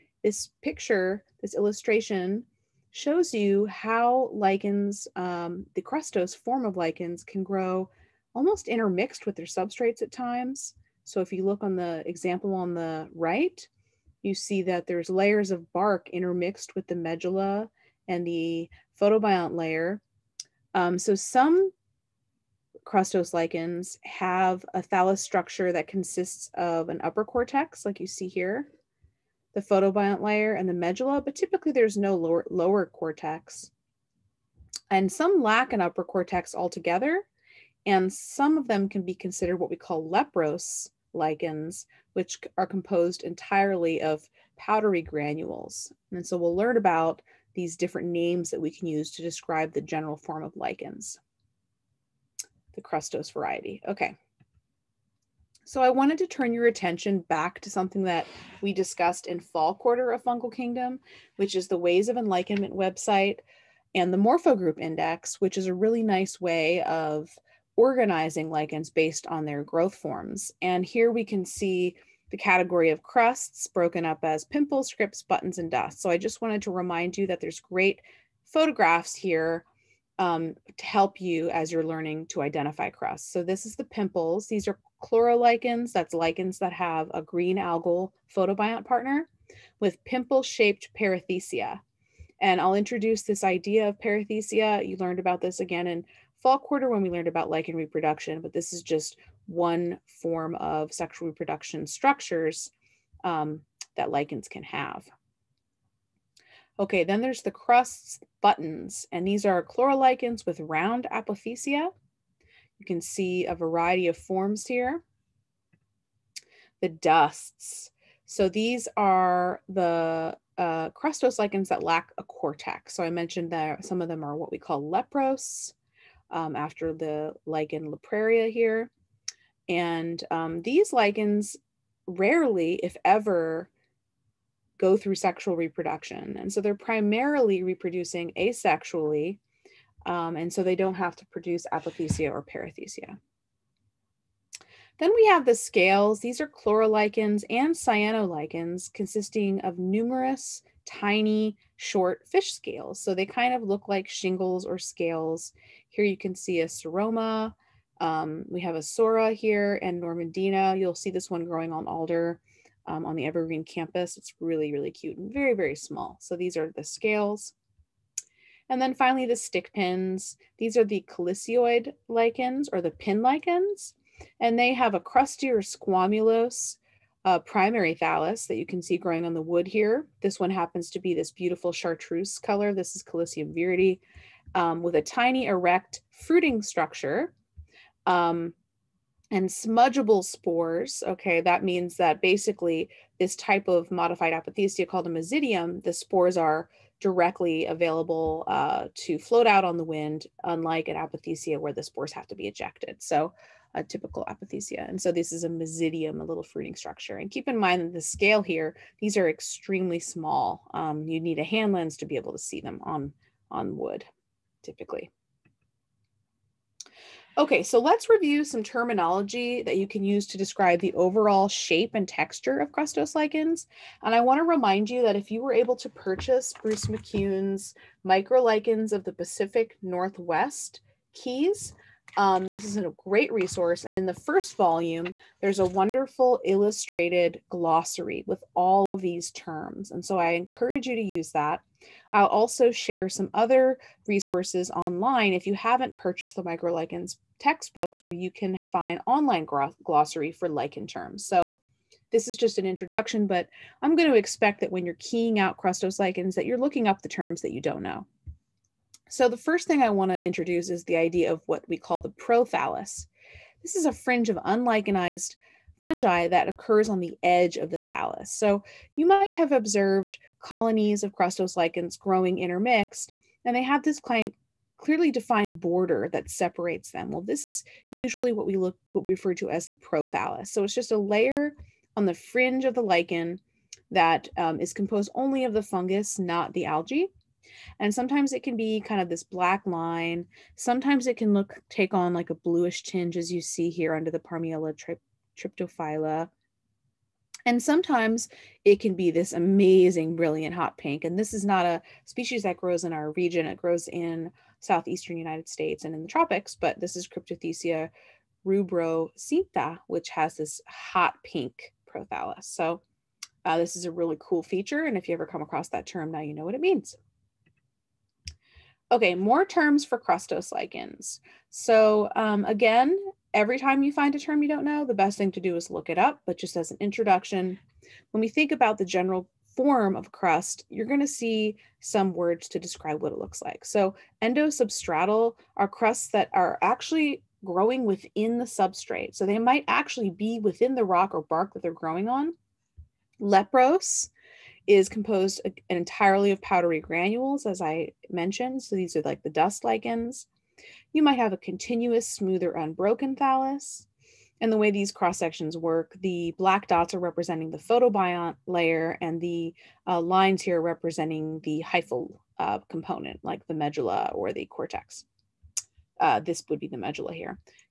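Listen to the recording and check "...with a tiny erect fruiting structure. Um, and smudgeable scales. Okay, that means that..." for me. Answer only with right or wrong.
wrong.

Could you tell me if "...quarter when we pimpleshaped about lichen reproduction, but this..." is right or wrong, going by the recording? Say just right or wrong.
wrong.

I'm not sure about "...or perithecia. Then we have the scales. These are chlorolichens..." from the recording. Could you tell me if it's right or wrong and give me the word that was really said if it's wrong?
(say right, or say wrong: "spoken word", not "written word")
right.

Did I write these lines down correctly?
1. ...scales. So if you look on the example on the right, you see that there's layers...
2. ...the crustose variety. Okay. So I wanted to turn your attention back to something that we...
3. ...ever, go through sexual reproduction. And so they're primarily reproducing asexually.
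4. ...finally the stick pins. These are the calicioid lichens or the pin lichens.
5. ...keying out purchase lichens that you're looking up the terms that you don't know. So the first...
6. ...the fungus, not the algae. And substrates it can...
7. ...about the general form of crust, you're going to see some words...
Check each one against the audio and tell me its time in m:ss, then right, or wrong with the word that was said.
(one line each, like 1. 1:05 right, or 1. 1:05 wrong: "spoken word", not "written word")
1. 0:10 wrong: "times", not "scales"
2. 0:52 right
3. 2:13 right
4. 2:48 right
5. 4:14 wrong: "crustose", not "purchase"
6. 4:45 wrong: "sometimes", not "substrates"
7. 5:28 right.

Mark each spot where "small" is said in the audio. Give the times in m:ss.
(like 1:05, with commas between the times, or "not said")
2:45, 3:30.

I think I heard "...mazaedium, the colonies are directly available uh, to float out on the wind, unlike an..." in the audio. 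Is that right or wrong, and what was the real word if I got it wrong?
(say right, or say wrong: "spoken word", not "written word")
wrong: "spores", not "colonies".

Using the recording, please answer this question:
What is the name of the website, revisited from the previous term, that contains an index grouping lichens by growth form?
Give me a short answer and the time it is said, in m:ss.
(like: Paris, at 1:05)
Ways of Enlichenment, at 1:01.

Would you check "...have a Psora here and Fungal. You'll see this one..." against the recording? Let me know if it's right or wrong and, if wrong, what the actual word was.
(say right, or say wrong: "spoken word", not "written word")
wrong: "Normandina", not "Fungal".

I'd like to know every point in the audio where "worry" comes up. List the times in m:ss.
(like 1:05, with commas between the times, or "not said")
not said.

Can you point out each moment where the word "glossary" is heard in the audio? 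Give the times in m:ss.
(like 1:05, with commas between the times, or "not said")
3:57, 4:09.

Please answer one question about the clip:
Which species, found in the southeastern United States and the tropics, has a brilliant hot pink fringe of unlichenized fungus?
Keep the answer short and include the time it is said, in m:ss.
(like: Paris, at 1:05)
Cryptothecia rubrocincta, at 5:07.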